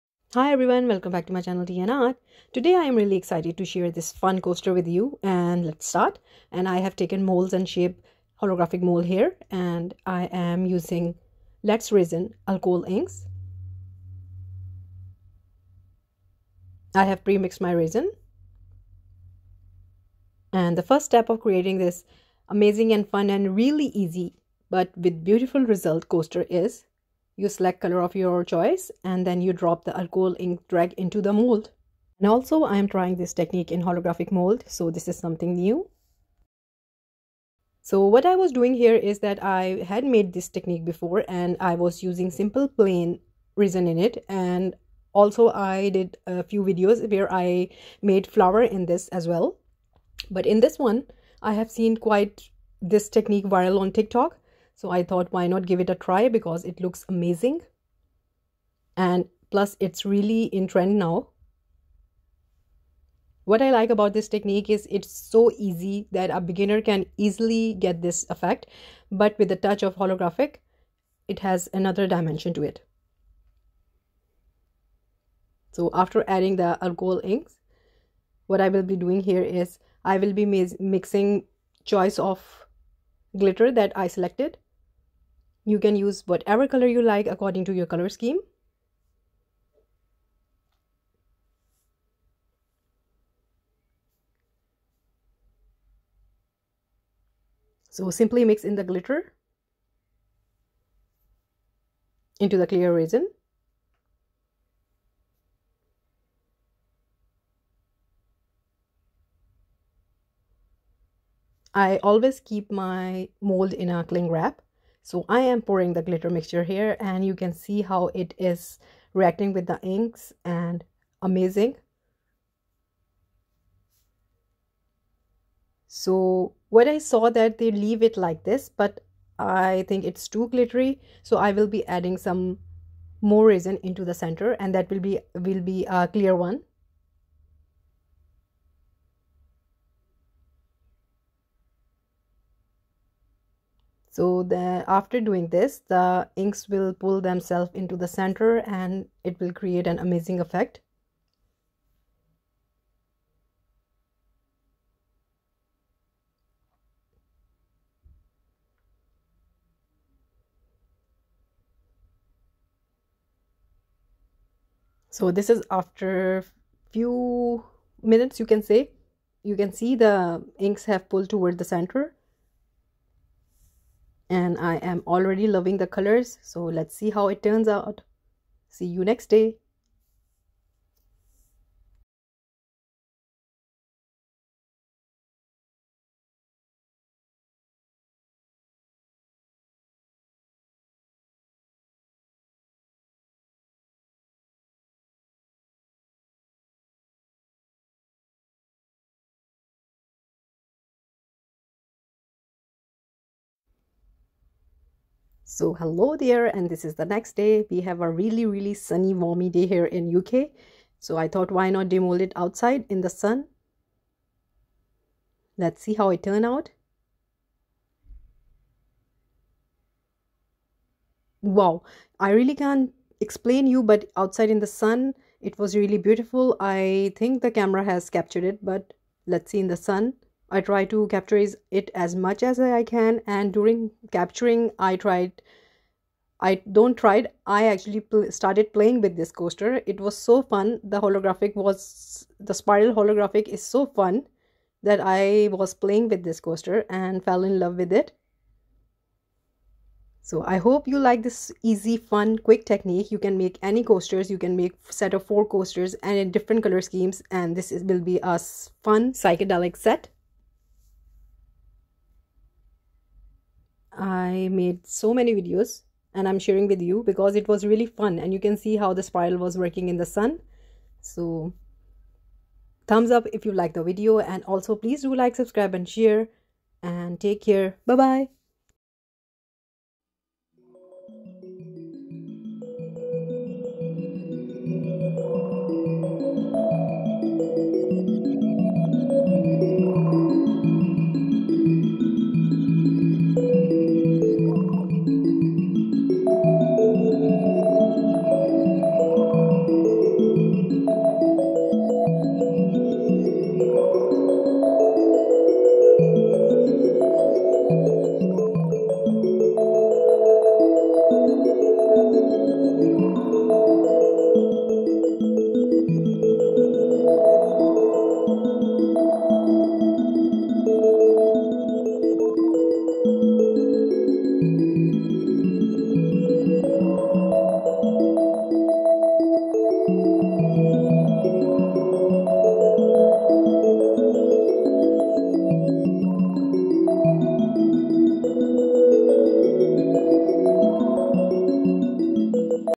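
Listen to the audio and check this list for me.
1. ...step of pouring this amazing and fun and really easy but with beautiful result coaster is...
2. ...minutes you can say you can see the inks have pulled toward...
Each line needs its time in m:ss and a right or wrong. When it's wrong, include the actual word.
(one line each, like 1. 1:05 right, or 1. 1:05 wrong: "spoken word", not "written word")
1. 0:21 wrong: "creating", not "pouring"
2. 2:48 right.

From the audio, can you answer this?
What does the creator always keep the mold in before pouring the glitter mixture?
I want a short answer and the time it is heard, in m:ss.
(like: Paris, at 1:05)
cling wrap, at 1:54.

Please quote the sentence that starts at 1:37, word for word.
So simply mix in the glitter into the clear resin.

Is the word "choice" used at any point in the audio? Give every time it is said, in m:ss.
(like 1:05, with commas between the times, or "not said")
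0:28, 1:21.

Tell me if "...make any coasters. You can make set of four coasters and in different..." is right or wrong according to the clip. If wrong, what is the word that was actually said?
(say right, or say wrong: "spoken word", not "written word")
right.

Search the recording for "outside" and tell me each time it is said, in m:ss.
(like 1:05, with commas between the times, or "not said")
3:32, 3:44.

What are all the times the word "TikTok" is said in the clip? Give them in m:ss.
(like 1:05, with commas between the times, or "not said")
0:53.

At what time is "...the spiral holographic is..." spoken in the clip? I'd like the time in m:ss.
4:02.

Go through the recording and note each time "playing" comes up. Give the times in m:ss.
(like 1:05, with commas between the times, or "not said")
3:58, 4:05.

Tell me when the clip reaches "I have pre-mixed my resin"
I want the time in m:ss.
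0:16.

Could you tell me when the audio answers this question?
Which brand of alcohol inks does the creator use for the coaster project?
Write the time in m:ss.
0:11.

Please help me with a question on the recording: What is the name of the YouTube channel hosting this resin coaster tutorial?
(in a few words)
Tea And Art.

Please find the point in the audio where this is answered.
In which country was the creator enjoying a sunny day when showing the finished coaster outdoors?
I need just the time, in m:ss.
3:30.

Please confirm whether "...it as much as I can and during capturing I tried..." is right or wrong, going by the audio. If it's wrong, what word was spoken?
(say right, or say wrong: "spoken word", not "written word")
right.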